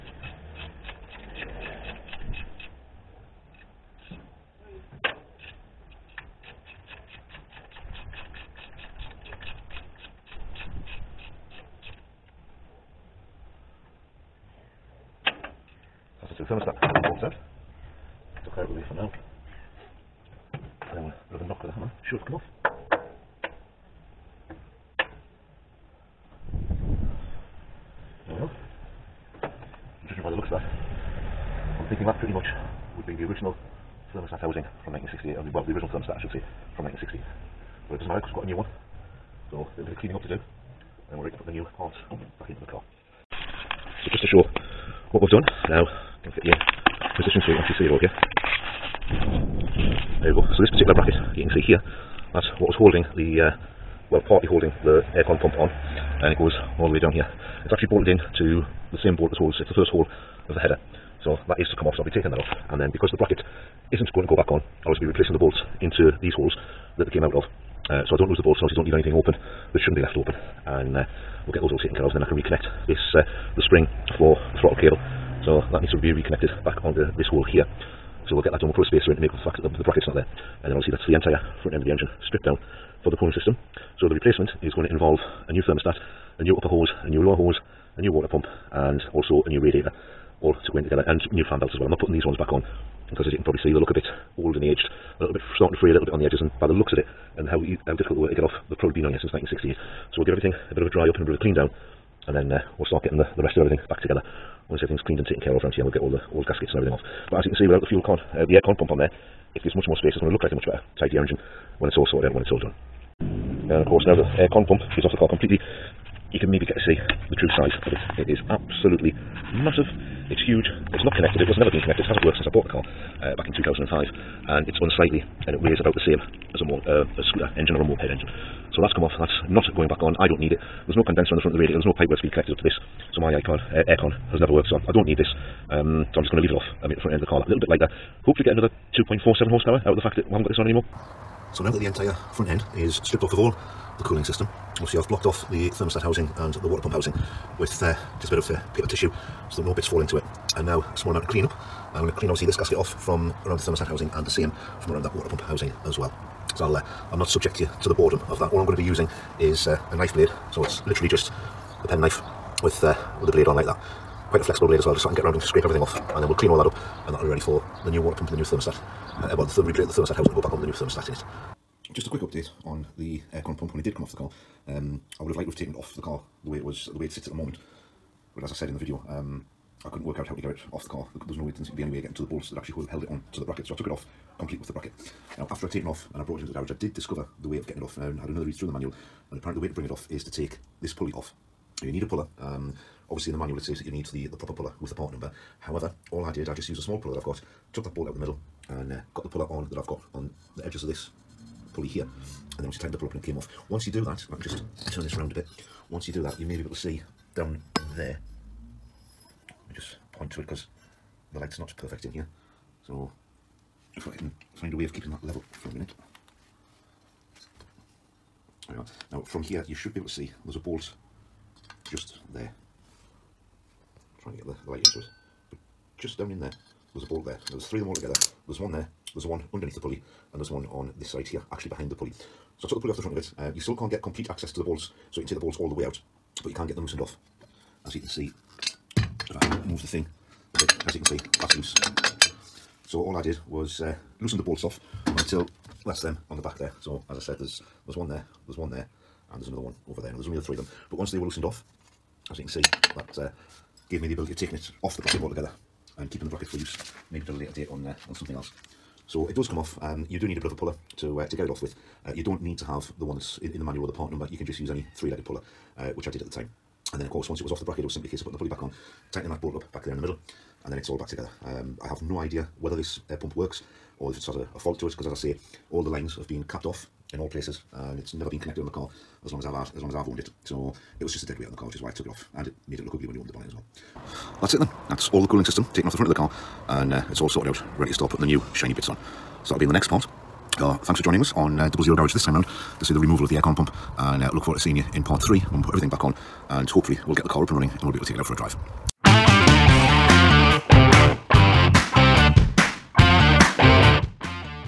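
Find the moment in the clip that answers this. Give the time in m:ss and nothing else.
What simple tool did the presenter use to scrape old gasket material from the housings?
2:41.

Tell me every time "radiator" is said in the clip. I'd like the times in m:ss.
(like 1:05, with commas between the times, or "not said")
1:29, 2:11.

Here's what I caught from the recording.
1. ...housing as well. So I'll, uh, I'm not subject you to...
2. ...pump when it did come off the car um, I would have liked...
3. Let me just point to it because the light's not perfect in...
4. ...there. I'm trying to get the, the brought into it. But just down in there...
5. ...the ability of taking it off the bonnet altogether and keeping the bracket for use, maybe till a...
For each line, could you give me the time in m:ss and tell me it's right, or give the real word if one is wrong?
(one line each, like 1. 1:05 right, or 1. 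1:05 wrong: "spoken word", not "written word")
1. 2:35 right
2. 2:53 right
3. 3:29 right
4. 3:42 wrong: "light", not "brought"
5. 4:14 wrong: "bracket", not "bonnet".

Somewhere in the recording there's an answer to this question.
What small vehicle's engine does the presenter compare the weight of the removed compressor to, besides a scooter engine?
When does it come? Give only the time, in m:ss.
2:07.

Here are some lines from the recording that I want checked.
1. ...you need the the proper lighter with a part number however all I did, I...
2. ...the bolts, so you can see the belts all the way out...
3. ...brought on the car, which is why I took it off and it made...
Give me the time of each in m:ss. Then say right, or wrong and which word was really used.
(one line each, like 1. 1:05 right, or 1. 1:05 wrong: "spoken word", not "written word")
1. 3:13 wrong: "puller", not "lighter"
2. 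3:54 wrong: "bolts", not "belts"
3. 4:41 wrong: "weight", not "brought".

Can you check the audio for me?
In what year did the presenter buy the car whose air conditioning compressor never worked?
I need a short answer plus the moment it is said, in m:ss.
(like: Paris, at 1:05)
2005, at 2:03.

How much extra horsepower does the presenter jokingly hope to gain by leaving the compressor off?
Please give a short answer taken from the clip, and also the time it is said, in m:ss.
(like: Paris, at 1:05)
2.47, at 2:18.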